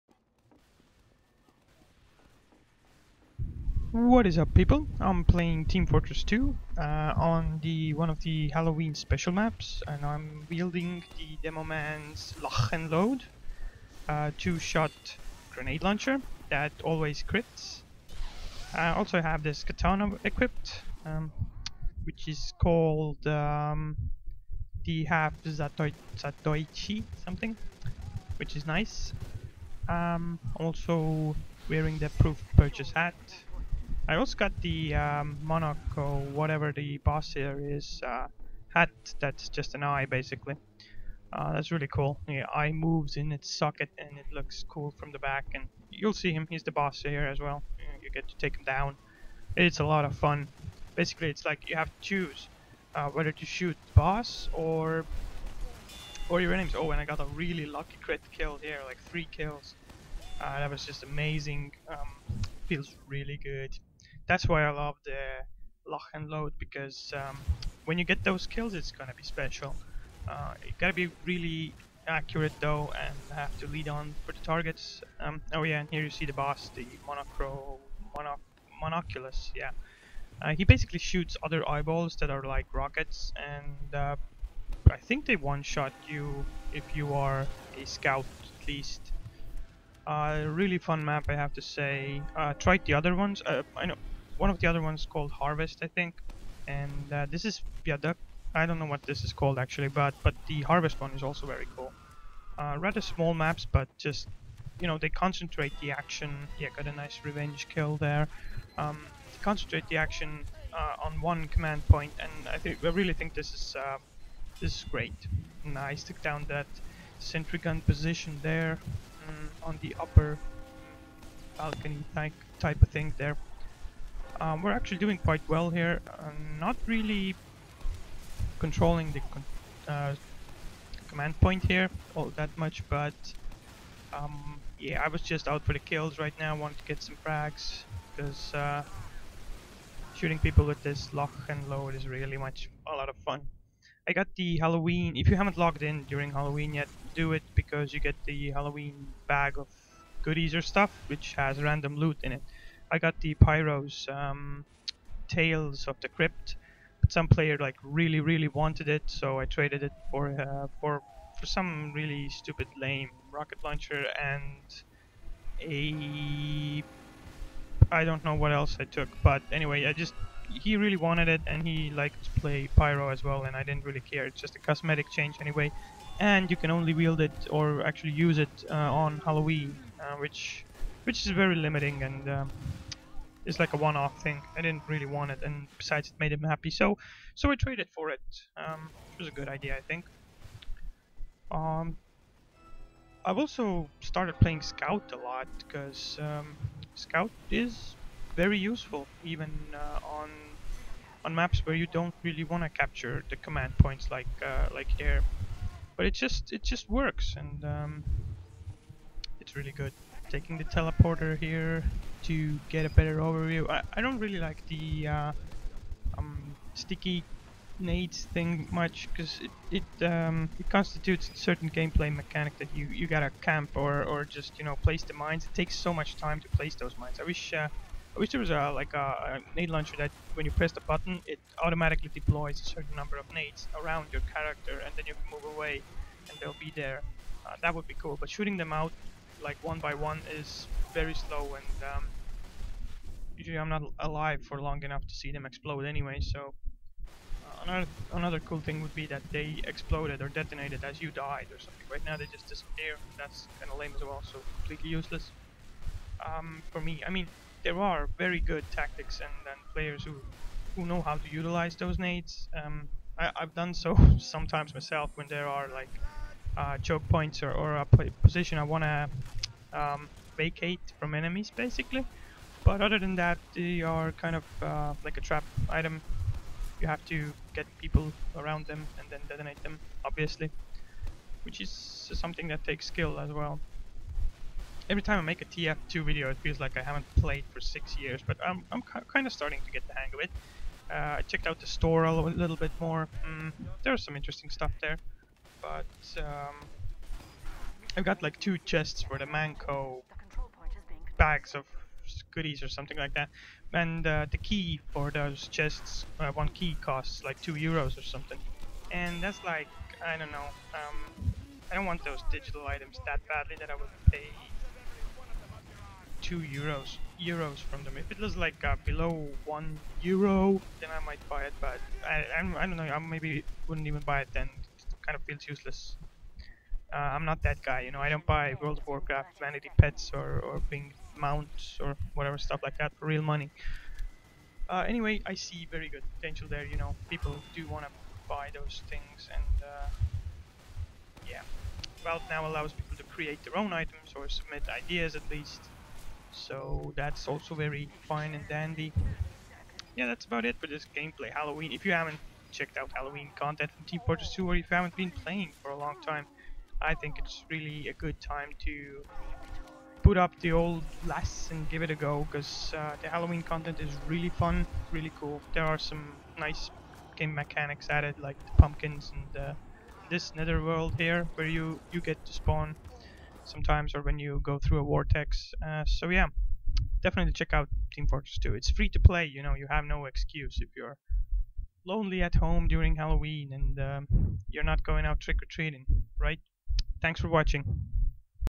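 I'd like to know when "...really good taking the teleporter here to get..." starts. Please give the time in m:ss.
3:29.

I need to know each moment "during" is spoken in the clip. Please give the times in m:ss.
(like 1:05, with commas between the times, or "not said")
2:26, 6:22.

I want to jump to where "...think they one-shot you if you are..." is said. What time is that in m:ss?
1:24.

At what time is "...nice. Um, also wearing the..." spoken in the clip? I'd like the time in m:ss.
0:28.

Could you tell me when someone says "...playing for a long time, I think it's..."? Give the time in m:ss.
5:55.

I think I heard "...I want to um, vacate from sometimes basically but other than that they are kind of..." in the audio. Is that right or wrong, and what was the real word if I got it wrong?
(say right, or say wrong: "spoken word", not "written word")
wrong: "enemies", not "sometimes".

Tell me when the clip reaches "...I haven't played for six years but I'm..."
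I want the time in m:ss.
4:46.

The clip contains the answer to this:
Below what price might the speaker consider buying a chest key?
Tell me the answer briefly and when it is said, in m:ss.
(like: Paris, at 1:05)
1 euro, at 5:19.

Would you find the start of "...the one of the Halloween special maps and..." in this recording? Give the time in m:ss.
0:07.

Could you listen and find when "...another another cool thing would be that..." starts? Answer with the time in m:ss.
4:07.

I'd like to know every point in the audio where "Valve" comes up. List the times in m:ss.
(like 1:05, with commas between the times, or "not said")
5:42.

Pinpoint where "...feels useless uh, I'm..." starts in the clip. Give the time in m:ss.
5:25.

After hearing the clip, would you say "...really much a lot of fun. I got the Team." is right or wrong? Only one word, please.
wrong.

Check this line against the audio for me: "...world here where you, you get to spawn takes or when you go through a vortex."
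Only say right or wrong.
wrong.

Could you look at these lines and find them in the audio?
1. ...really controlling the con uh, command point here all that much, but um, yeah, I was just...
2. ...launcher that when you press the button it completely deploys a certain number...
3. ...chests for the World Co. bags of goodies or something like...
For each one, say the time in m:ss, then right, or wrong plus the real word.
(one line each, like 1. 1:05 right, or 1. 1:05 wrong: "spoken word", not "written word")
1. 2:06 right
2. 3:49 wrong: "automatically", not "completely"
3. 4:58 wrong: "Mann", not "World".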